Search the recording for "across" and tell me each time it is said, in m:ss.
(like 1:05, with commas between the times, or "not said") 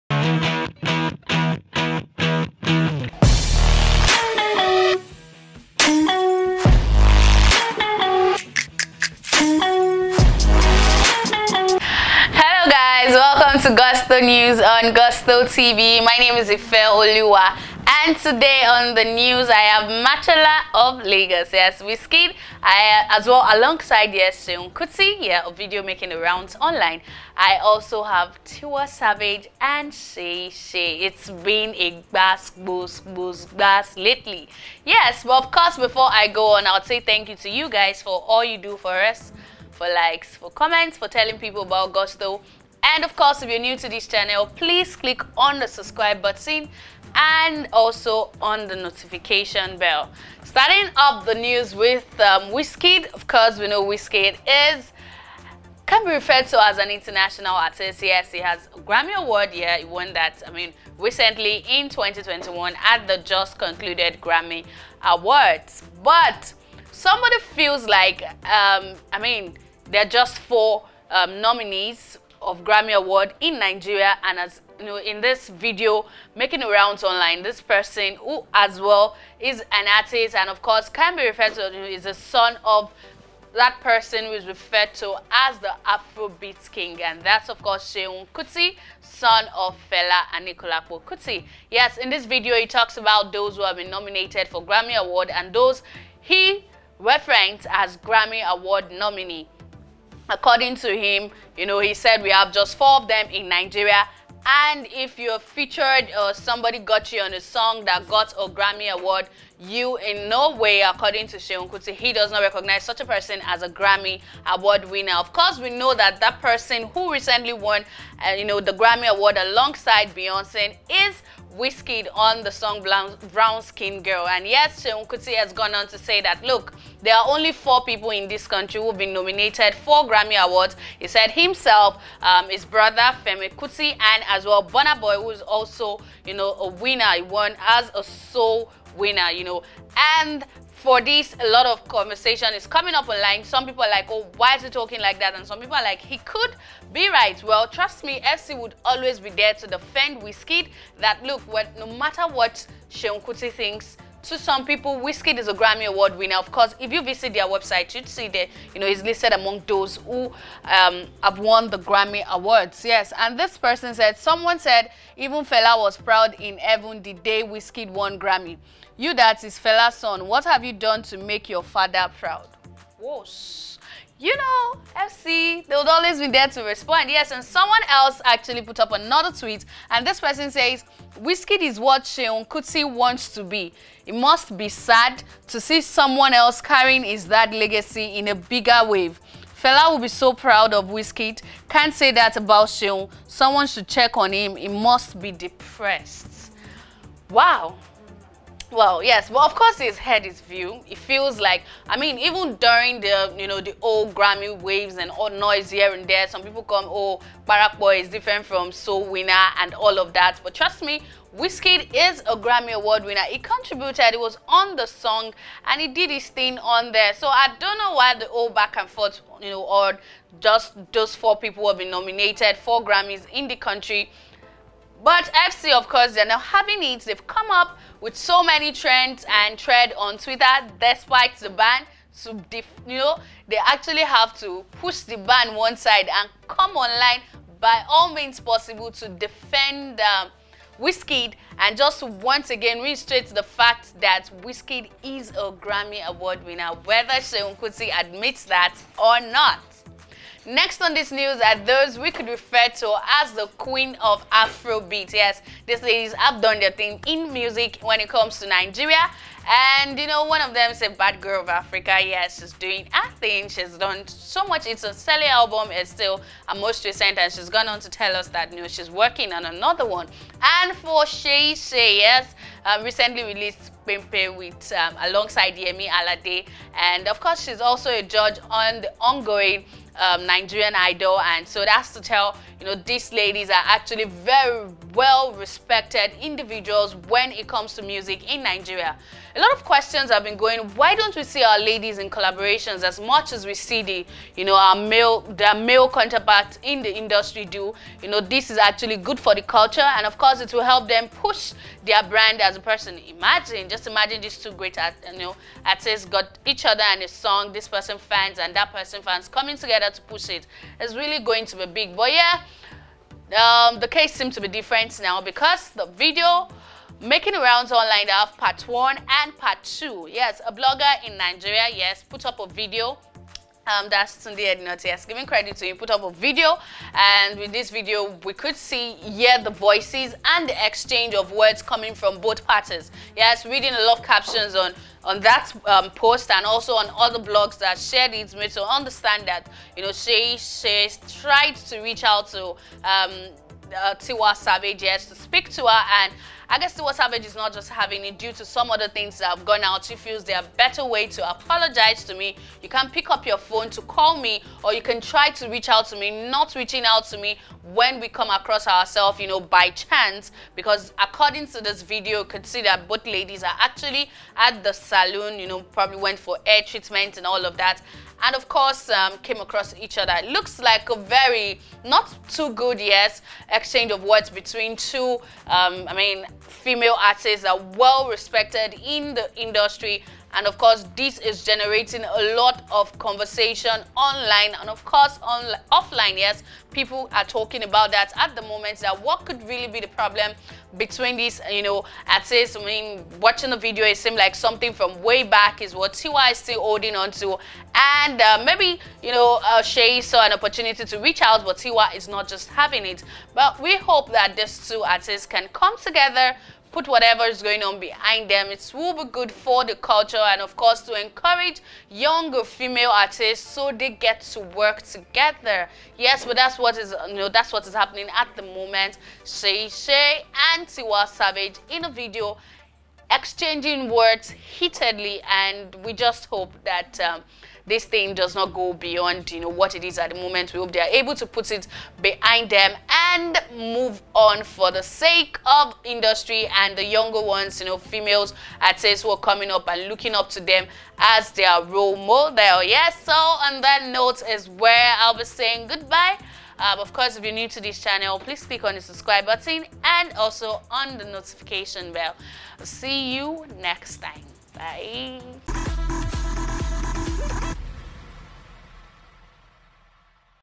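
5:58, 6:09.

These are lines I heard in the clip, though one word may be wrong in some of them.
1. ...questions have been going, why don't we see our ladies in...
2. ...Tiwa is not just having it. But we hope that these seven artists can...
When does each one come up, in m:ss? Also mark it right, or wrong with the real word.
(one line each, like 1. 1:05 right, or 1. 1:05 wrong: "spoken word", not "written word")
1. 4:49 right
2. 6:41 wrong: "two", not "seven".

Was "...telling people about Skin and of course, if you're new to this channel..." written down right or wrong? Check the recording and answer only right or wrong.
wrong.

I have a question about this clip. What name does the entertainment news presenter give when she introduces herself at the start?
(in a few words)
Ife Oluwa.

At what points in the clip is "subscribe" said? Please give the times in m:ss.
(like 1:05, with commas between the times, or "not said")
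0:45, 7:28.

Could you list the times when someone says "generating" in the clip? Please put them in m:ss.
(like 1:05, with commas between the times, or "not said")
6:21.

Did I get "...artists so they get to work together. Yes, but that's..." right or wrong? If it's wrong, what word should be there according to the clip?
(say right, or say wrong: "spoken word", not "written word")
right.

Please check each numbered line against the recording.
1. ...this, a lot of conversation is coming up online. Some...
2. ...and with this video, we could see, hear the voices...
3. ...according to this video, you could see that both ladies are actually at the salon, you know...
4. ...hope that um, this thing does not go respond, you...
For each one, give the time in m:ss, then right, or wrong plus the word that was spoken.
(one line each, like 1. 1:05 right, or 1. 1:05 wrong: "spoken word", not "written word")
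1. 2:21 right
2. 5:26 right
3. 6:01 right
4. 7:06 wrong: "beyond", not "respond".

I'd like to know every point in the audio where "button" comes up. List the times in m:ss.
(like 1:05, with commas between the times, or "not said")
0:46, 7:29.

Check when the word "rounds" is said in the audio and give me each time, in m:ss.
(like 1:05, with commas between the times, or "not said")
0:26, 1:16, 5:17.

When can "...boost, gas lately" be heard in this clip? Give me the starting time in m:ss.
0:33.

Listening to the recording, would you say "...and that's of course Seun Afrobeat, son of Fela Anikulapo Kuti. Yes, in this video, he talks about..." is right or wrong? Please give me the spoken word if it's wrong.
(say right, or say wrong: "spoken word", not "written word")
wrong: "Kuti", not "Afrobeat".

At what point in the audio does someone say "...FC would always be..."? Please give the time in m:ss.
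2:28.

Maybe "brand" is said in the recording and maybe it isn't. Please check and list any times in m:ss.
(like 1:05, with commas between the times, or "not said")
5:02.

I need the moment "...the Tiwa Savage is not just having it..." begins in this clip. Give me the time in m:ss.
5:46.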